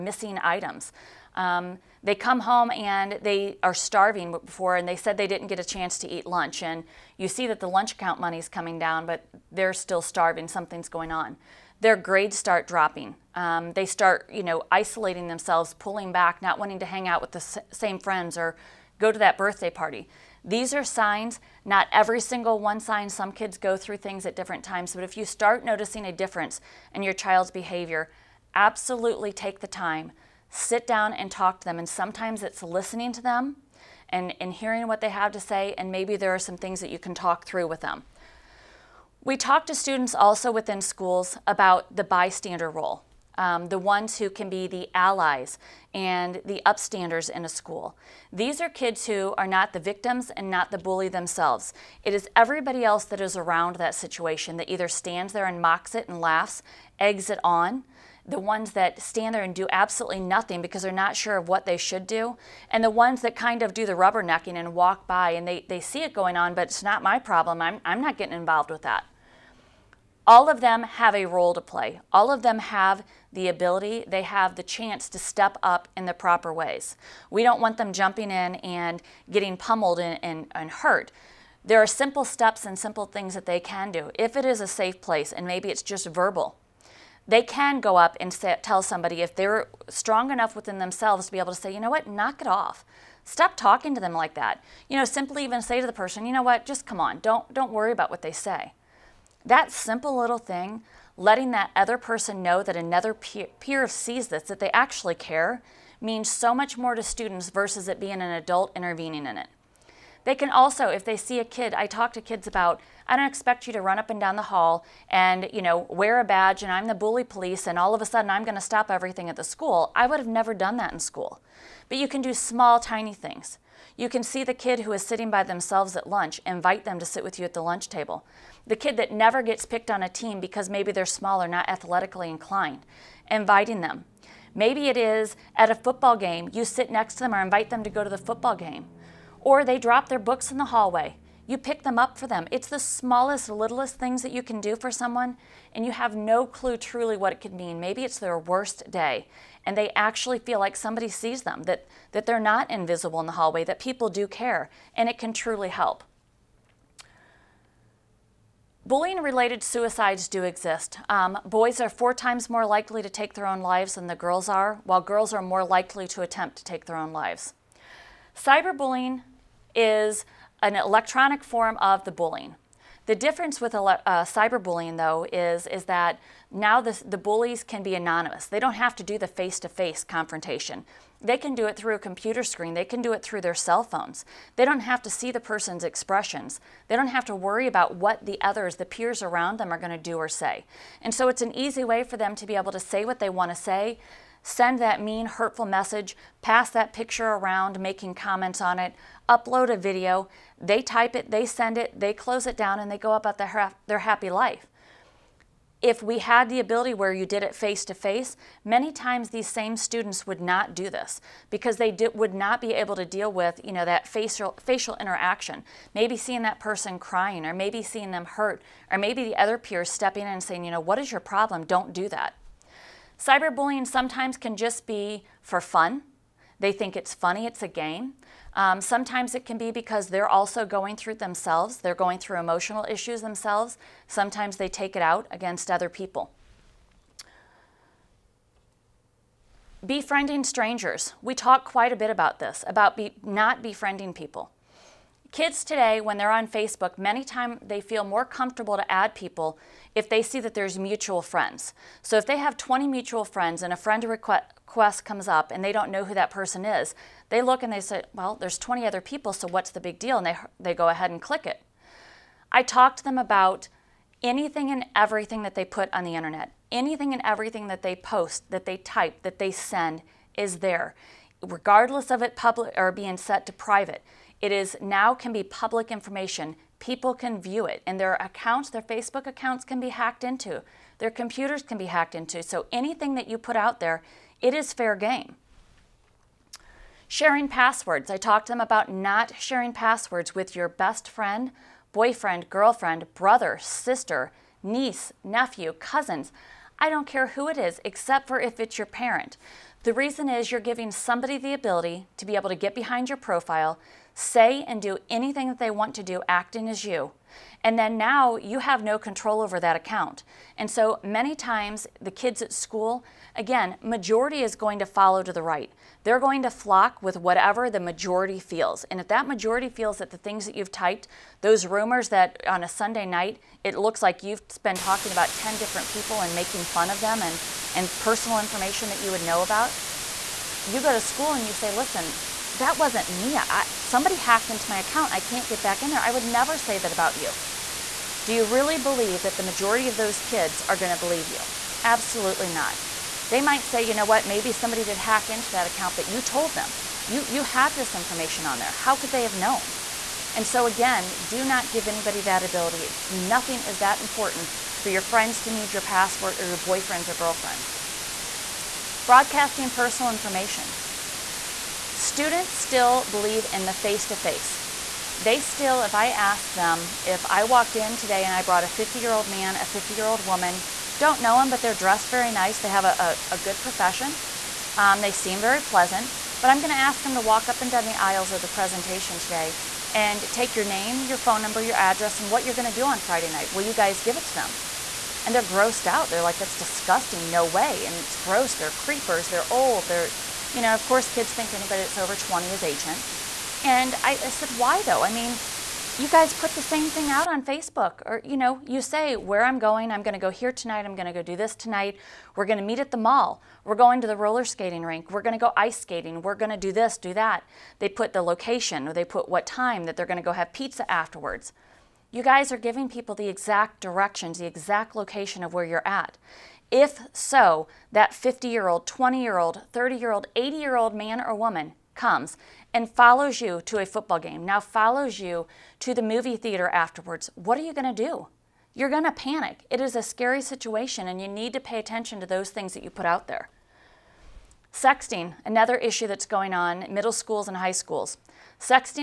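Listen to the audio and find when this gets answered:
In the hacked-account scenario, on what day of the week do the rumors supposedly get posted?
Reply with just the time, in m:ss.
5:22.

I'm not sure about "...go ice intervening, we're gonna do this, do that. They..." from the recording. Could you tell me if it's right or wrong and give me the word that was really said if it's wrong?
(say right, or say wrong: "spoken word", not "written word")
wrong: "skating", not "intervening".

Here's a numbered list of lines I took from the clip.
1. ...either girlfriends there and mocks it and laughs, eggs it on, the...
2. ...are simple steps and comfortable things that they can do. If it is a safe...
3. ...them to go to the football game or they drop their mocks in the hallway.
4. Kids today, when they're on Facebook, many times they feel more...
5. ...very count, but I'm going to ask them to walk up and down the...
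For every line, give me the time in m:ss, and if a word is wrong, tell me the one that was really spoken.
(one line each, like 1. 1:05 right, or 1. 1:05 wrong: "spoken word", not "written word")
1. 0:54 wrong: "stands", not "girlfriends"
2. 1:21 wrong: "simple", not "comfortable"
3. 2:17 wrong: "books", not "mocks"
4. 4:05 right
5. 6:15 wrong: "pleasant", not "count".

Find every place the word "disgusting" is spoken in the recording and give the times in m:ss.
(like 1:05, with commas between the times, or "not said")
6:26.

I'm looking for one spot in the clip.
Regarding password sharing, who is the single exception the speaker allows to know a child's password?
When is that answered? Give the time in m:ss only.
4:58.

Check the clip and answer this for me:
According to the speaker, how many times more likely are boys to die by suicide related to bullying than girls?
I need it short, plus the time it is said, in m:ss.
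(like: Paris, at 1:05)
4 times, at 2:41.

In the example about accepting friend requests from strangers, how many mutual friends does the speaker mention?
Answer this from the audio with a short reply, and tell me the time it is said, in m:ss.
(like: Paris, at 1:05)
20, at 4:12.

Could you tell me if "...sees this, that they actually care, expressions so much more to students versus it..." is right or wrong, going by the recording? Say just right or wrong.
wrong.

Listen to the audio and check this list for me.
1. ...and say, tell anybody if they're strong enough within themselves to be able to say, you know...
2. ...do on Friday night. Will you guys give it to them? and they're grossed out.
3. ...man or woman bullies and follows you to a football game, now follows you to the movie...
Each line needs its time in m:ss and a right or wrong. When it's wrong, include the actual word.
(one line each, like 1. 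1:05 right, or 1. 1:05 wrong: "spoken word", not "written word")
1. 1:28 wrong: "somebody", not "anybody"
2. 6:22 right
3. 7:00 wrong: "comes", not "bullies".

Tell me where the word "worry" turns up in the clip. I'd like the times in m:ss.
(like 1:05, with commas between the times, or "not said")
1:37, 3:07.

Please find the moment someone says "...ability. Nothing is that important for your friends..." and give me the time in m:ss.
5:52.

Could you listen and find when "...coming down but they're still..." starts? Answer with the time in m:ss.
0:08.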